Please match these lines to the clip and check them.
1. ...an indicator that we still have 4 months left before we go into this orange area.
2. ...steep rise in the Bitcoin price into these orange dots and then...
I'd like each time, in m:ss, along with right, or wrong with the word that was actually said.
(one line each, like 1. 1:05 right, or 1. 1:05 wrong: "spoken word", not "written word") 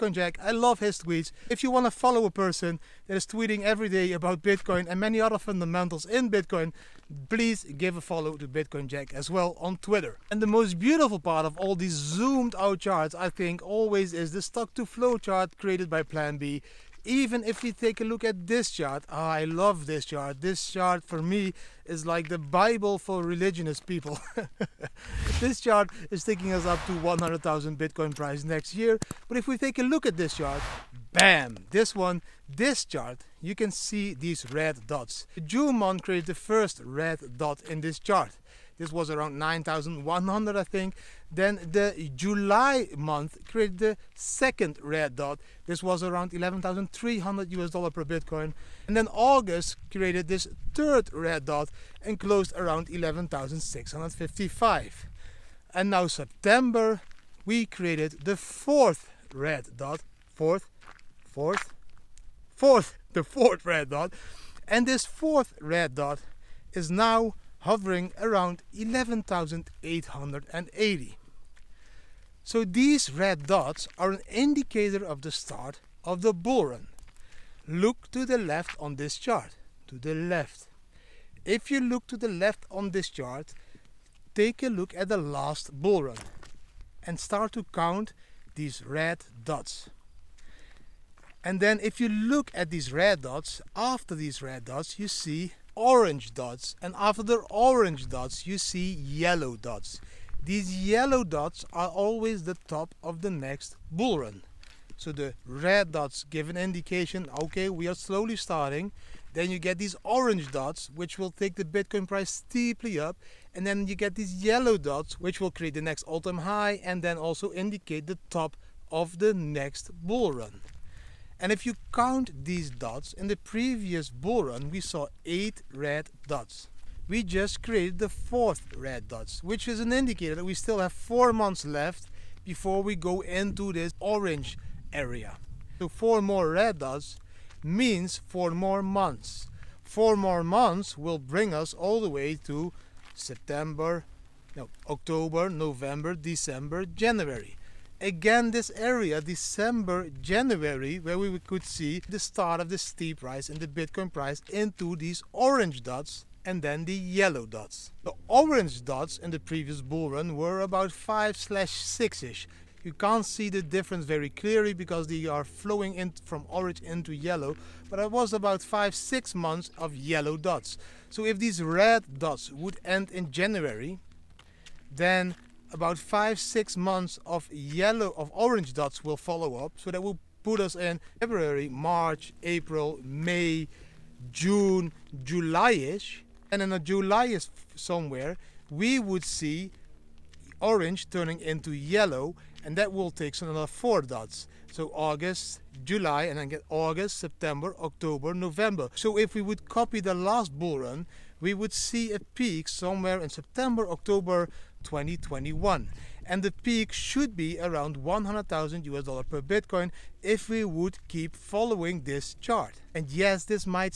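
1. 2:09 right
2. 2:32 right.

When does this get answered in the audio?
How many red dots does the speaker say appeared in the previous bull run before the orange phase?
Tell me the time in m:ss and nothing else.
2:05.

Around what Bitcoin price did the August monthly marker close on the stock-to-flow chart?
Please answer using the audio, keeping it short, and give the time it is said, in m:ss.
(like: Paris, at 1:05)
11,655, at 0:52.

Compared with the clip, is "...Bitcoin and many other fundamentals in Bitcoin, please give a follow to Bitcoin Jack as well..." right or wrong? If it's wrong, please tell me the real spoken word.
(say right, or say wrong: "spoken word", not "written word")
right.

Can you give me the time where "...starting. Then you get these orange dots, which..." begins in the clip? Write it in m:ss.
1:48.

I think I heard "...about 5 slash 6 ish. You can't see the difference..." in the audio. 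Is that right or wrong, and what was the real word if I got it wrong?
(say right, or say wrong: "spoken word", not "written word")
right.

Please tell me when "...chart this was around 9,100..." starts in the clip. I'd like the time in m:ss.
0:37.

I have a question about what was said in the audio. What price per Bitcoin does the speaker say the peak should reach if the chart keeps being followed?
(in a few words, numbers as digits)
100,000 US dollars.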